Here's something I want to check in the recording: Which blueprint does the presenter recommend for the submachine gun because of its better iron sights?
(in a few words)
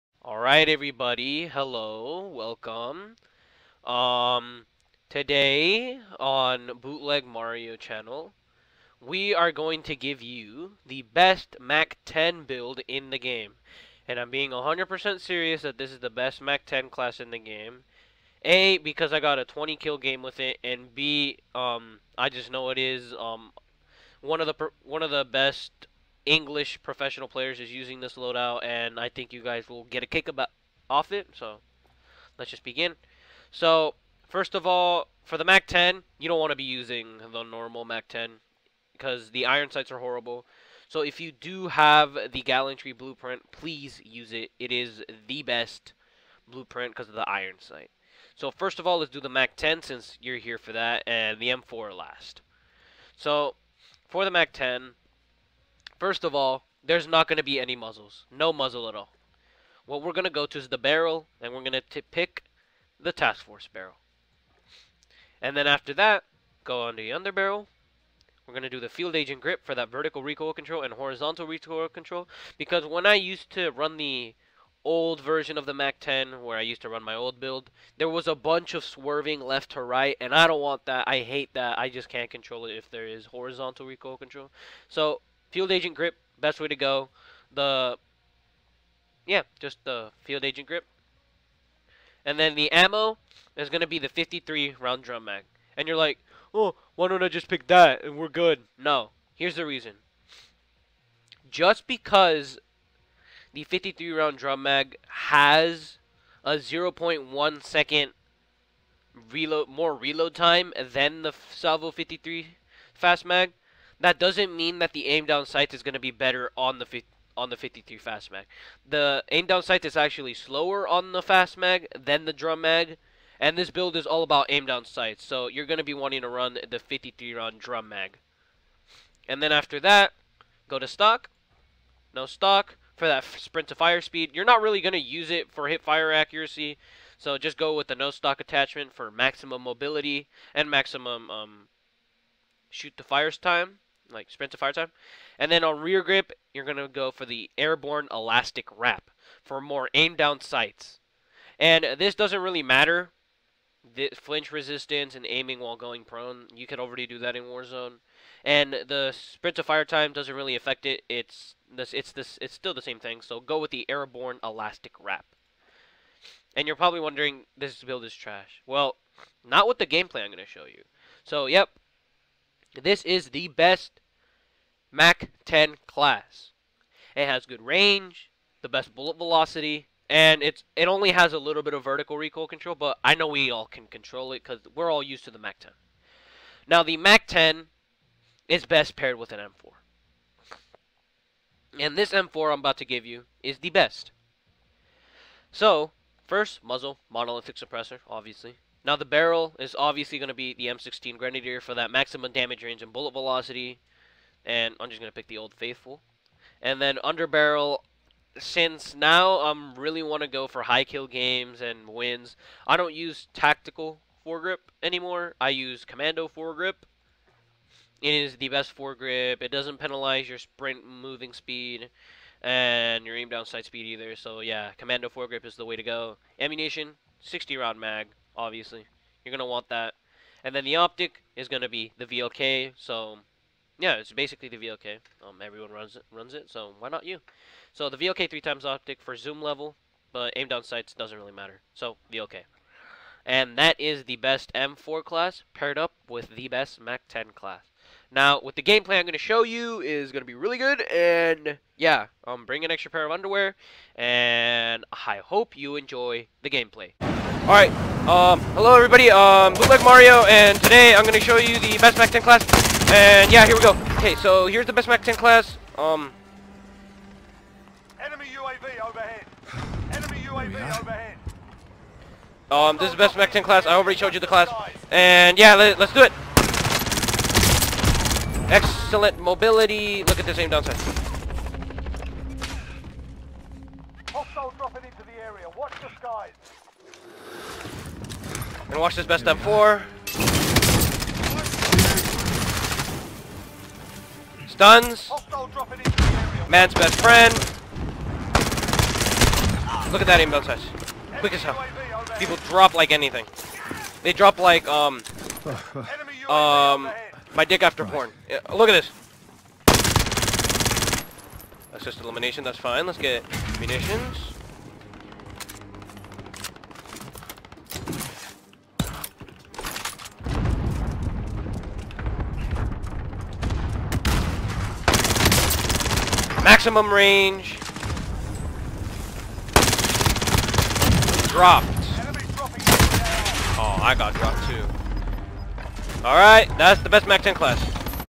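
Gallantry.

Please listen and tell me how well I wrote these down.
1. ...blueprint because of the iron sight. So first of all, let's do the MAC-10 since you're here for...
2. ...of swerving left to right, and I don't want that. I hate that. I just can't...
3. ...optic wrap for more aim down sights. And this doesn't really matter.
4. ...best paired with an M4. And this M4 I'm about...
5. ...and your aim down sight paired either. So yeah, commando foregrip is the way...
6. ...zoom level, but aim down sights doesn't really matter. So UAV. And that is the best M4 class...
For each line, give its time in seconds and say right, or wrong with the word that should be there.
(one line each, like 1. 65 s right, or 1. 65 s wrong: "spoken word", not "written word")
1. 46 s right
2. 78 s right
3. 148 s wrong: "elastic", not "optic"
4. 188 s right
5. 222 s wrong: "speed", not "paired"
6. 239 s wrong: "VLK", not "UAV".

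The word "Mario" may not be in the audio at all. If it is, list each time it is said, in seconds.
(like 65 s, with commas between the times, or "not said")
7 s, 259 s.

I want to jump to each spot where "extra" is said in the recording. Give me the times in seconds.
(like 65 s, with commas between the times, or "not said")
252 s.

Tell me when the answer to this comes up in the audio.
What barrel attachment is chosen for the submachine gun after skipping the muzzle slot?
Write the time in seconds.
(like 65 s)
63 s.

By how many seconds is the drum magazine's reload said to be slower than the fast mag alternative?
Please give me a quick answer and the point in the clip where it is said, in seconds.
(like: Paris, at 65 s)
0.1 seconds, at 106 s.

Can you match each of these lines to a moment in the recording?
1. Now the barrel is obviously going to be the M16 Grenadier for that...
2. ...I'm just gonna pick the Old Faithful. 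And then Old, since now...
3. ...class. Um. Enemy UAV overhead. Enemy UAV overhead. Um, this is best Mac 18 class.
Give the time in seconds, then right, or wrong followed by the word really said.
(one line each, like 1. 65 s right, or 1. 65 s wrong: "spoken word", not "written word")
1. 198 s right
2. 204 s wrong: "Underbarrel", not "Old"
3. 265 s wrong: "10", not "18".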